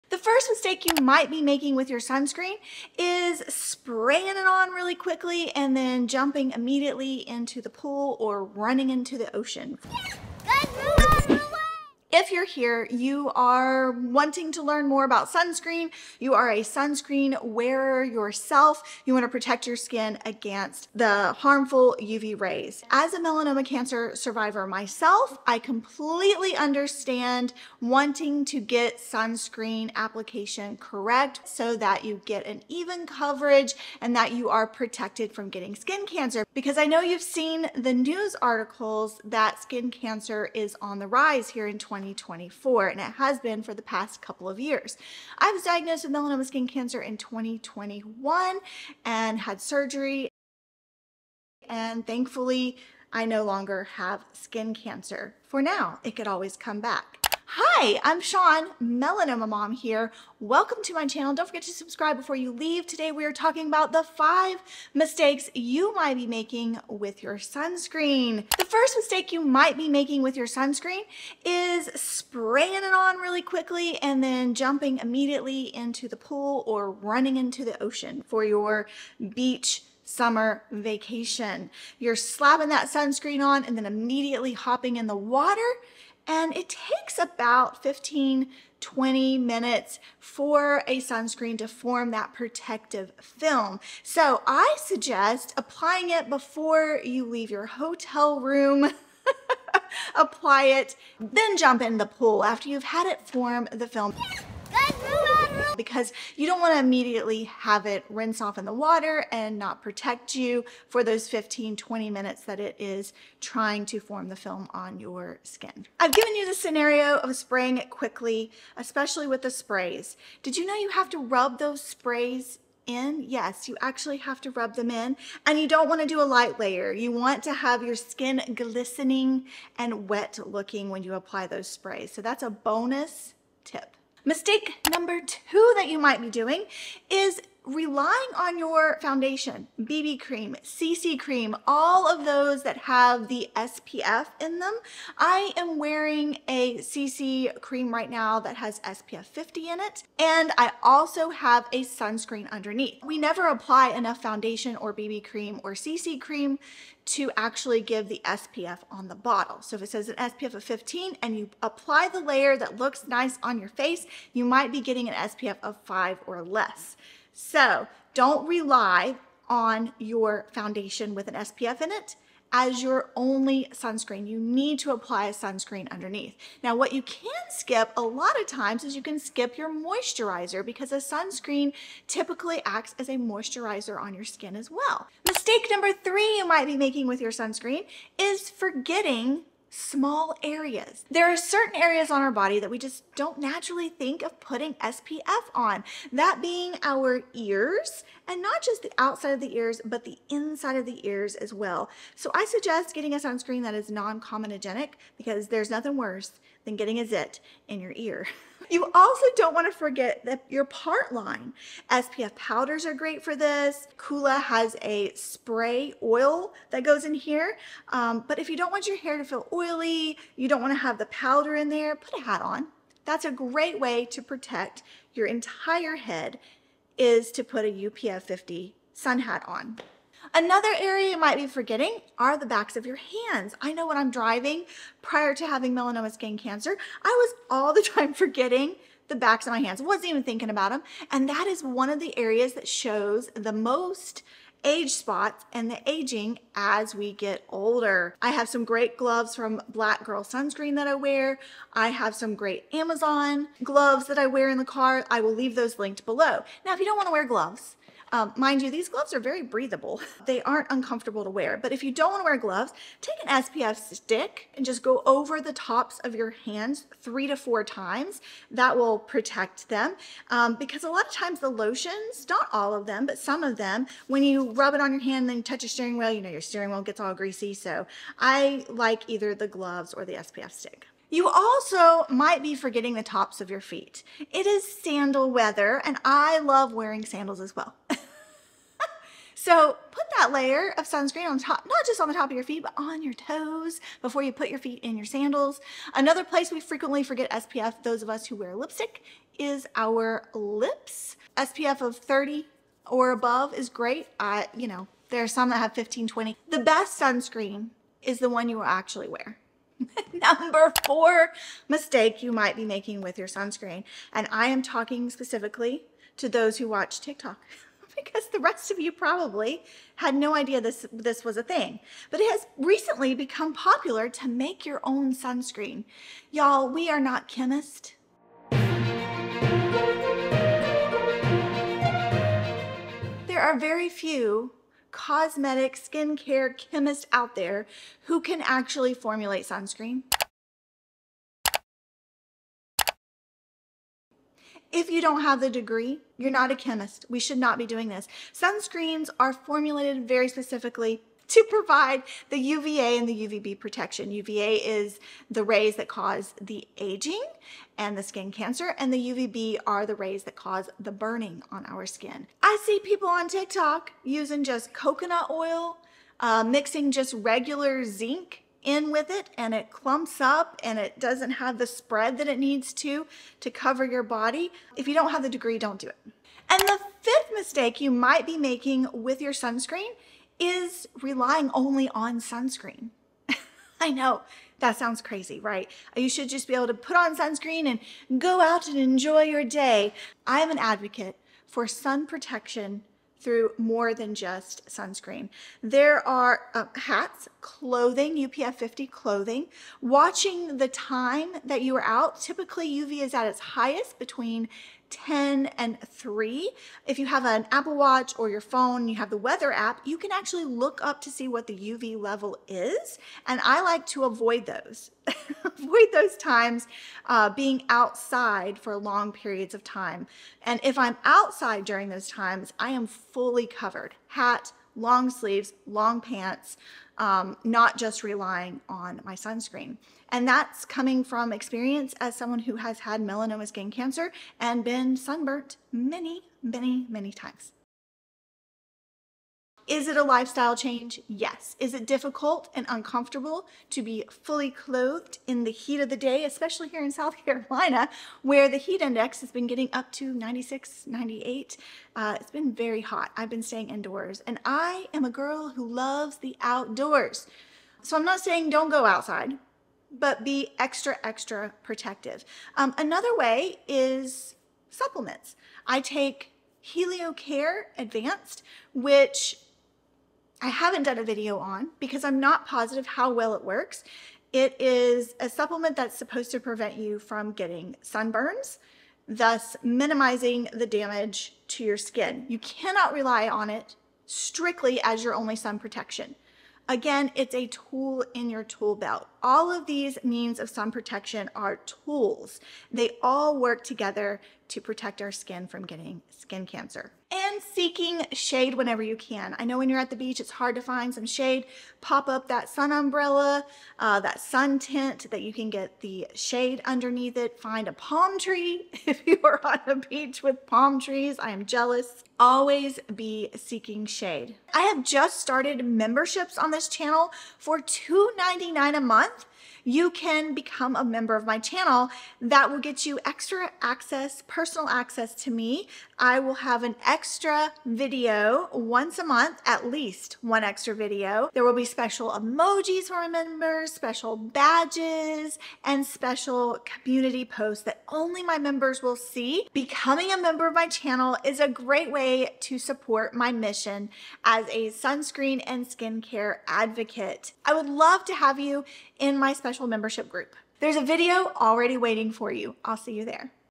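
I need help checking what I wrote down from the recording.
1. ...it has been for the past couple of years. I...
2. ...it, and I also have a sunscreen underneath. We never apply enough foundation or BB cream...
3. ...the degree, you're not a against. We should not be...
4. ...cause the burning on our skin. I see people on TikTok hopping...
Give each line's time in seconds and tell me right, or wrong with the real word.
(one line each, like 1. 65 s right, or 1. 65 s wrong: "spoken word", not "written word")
1. 42 s right
2. 149 s right
3. 345 s wrong: "chemist", not "against"
4. 360 s wrong: "using", not "hopping".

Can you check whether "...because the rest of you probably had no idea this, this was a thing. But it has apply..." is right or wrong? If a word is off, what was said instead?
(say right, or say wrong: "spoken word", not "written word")
wrong: "recently", not "apply".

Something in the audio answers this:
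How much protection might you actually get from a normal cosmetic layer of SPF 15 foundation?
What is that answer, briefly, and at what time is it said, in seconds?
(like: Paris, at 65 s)
SPF 5 or less, at 165 s.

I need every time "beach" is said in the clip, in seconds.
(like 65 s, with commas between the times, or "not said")
79 s, 499 s, 509 s.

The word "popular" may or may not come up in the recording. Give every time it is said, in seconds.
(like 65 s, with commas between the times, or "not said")
323 s.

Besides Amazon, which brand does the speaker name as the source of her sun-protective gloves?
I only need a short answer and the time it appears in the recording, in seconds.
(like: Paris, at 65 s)
Black Girl Sunscreen, at 249 s.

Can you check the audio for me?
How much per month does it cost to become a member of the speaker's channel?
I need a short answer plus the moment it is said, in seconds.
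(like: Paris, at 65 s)
$2.99, at 517 s.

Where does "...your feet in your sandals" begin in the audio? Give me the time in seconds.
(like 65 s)
294 s.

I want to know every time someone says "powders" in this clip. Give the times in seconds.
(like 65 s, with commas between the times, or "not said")
212 s, 221 s.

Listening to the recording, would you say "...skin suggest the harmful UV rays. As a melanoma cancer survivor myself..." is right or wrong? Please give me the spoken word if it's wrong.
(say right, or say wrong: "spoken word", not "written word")
wrong: "against", not "suggest".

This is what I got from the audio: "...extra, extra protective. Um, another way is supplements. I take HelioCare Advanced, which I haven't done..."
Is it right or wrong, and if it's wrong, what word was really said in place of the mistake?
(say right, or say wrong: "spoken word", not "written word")
right.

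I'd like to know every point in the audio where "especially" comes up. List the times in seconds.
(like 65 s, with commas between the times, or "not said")
118 s, 446 s.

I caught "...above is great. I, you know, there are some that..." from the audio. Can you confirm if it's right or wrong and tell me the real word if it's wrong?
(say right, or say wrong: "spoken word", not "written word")
right.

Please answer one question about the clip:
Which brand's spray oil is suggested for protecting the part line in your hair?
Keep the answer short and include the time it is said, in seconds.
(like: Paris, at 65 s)
Coola, at 213 s.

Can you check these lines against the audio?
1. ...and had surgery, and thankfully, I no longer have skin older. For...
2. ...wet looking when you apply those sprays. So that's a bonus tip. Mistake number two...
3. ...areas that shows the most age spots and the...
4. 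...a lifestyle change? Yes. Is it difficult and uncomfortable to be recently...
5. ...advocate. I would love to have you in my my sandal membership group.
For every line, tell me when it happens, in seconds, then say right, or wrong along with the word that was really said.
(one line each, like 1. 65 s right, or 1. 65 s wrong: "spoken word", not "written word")
1. 49 s wrong: "cancer", not "older"
2. 130 s right
3. 242 s right
4. 439 s wrong: "fully", not "recently"
5. 546 s wrong: "special", not "sandal".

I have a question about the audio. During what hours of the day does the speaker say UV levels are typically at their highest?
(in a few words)
Between 10 and 3.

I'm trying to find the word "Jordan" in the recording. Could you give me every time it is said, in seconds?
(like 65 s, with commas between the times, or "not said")
not said.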